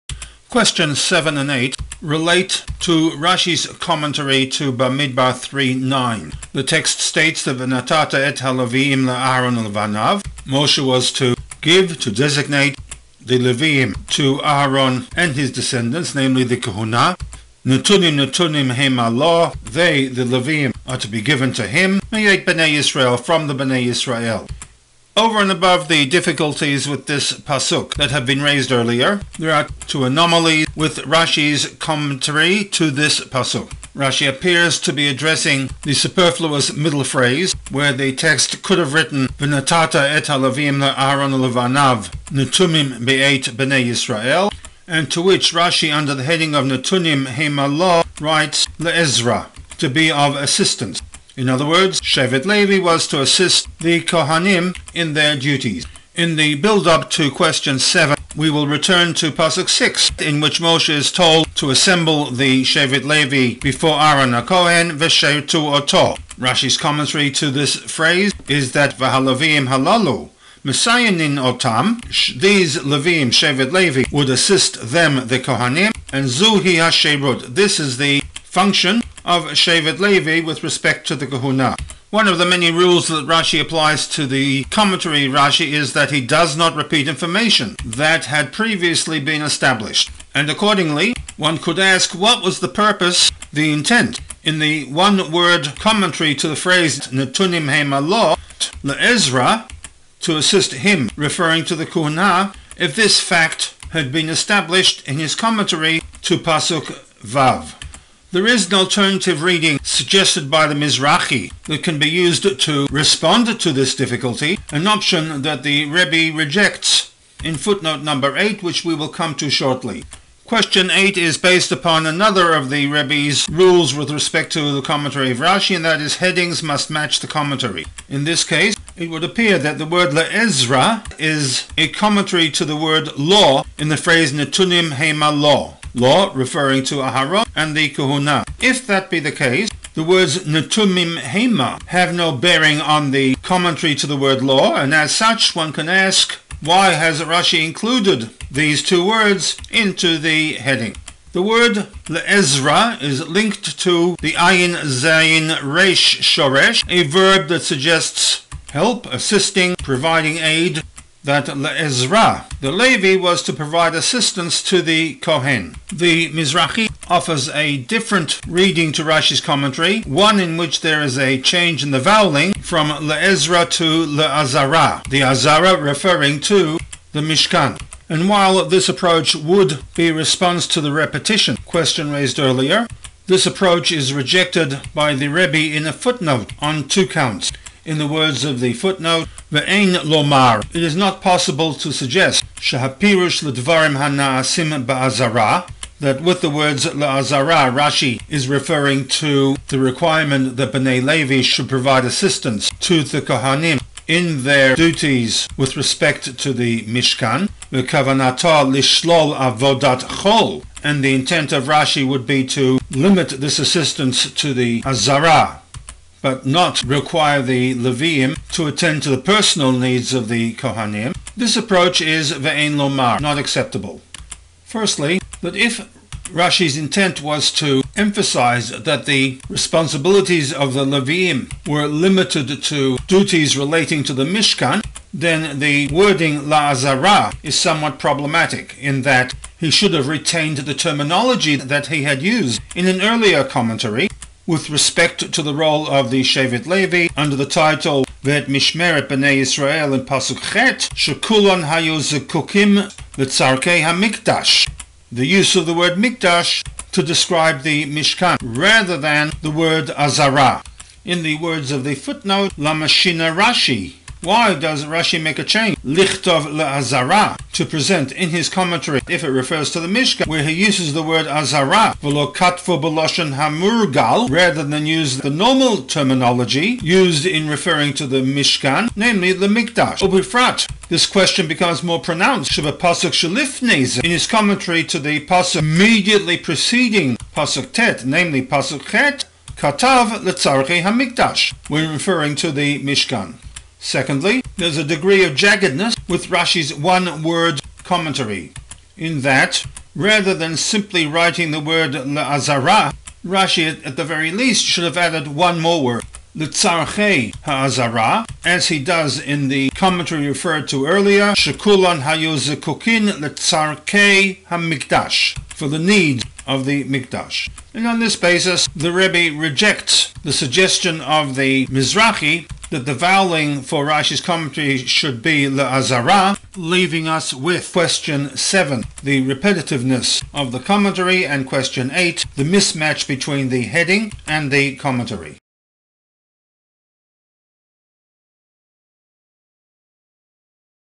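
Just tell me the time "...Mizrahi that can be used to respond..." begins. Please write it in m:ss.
1:50.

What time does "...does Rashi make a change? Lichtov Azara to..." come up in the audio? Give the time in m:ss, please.
4:24.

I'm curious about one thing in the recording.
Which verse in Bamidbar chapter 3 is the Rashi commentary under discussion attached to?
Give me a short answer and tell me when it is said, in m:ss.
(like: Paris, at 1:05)
Bamidbar 3:9, at 0:04.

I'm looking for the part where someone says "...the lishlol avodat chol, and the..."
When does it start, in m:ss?
3:27.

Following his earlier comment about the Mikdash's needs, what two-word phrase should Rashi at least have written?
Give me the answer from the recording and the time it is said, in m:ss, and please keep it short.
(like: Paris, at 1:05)
Litzarchei Ha'azara, at 5:06.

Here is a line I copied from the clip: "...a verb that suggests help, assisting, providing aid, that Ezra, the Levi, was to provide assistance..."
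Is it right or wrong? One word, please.
right.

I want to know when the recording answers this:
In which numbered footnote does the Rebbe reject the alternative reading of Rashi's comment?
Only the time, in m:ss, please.
1:57.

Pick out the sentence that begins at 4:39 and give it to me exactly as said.
Ubifrat, this question becomes more pronounced.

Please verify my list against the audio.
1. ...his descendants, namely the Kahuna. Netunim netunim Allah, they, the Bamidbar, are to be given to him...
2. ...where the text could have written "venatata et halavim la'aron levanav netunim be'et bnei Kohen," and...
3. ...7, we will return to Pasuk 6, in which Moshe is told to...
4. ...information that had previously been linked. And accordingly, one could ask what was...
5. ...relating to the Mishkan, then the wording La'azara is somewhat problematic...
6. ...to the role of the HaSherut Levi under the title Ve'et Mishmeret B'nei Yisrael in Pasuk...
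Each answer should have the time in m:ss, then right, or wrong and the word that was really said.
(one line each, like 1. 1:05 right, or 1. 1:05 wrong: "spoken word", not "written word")
1. 0:15 wrong: "Levim", not "Bamidbar"
2. 0:37 wrong: "Yisrael", not "Kohen"
3. 0:57 right
4. 1:27 wrong: "established", not "linked"
5. 3:53 right
6. 4:05 wrong: "Shevet", not "HaSherut".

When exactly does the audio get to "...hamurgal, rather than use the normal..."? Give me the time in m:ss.
4:33.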